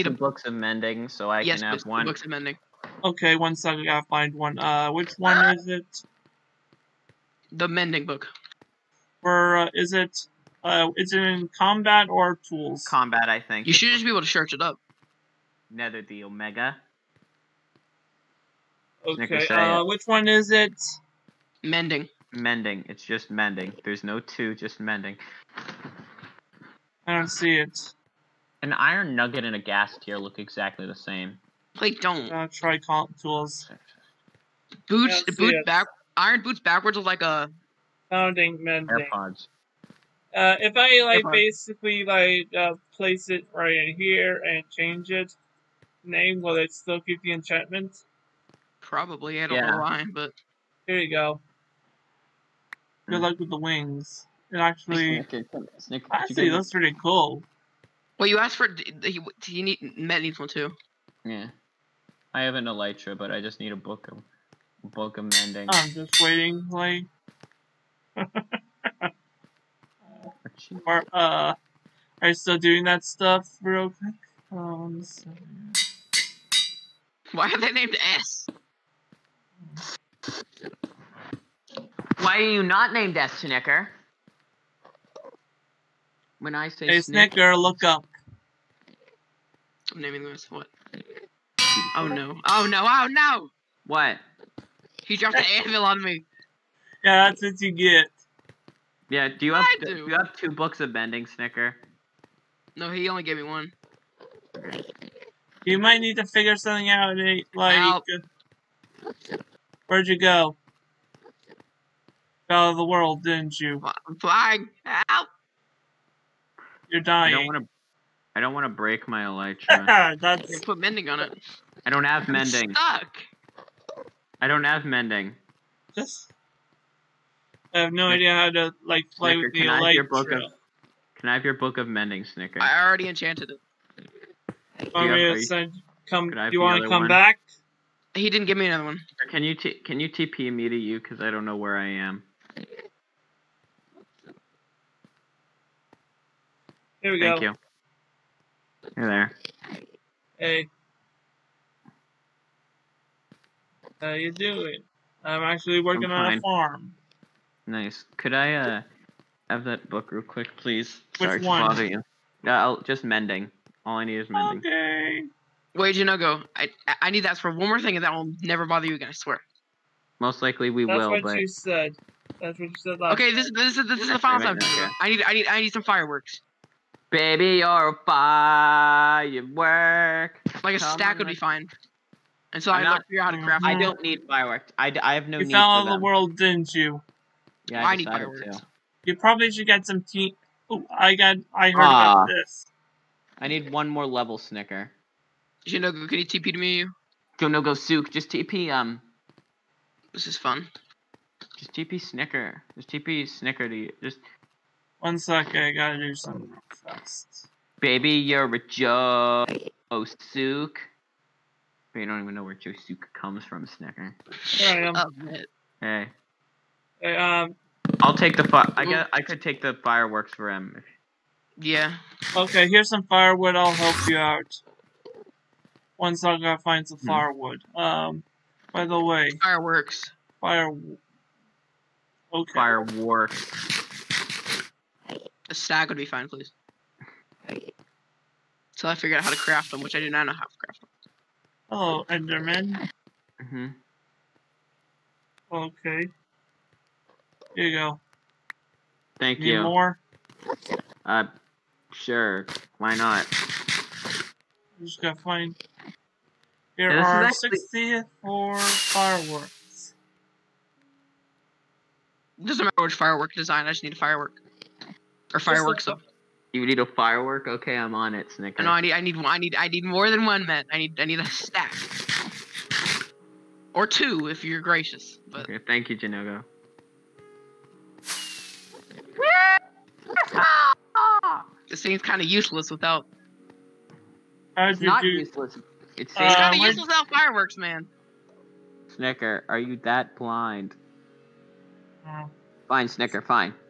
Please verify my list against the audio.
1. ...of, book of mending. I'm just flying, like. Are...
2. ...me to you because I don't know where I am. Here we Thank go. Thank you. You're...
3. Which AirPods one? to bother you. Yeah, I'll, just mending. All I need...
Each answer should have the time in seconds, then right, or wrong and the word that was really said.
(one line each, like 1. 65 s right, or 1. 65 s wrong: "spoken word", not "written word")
1. 64 s wrong: "waiting", not "flying"
2. 140 s right
3. 161 s wrong: "Sorry", not "AirPods".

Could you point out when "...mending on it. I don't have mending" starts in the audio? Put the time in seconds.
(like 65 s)
120 s.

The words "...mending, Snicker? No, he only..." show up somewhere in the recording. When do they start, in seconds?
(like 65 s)
100 s.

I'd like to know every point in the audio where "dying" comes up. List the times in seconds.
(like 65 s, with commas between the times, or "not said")
117 s.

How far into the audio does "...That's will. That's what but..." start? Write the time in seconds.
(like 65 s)
170 s.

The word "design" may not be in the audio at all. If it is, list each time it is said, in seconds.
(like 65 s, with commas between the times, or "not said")
263 s.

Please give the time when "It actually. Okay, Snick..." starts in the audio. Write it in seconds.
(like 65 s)
54 s.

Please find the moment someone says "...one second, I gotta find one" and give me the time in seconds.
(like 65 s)
3 s.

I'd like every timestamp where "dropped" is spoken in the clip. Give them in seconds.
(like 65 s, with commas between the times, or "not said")
95 s.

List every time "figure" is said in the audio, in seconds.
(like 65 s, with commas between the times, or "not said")
106 s, 183 s, 238 s.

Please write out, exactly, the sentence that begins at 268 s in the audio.
No, I need, I need, I need, I need more than one, man.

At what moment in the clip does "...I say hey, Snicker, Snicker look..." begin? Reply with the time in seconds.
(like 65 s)
86 s.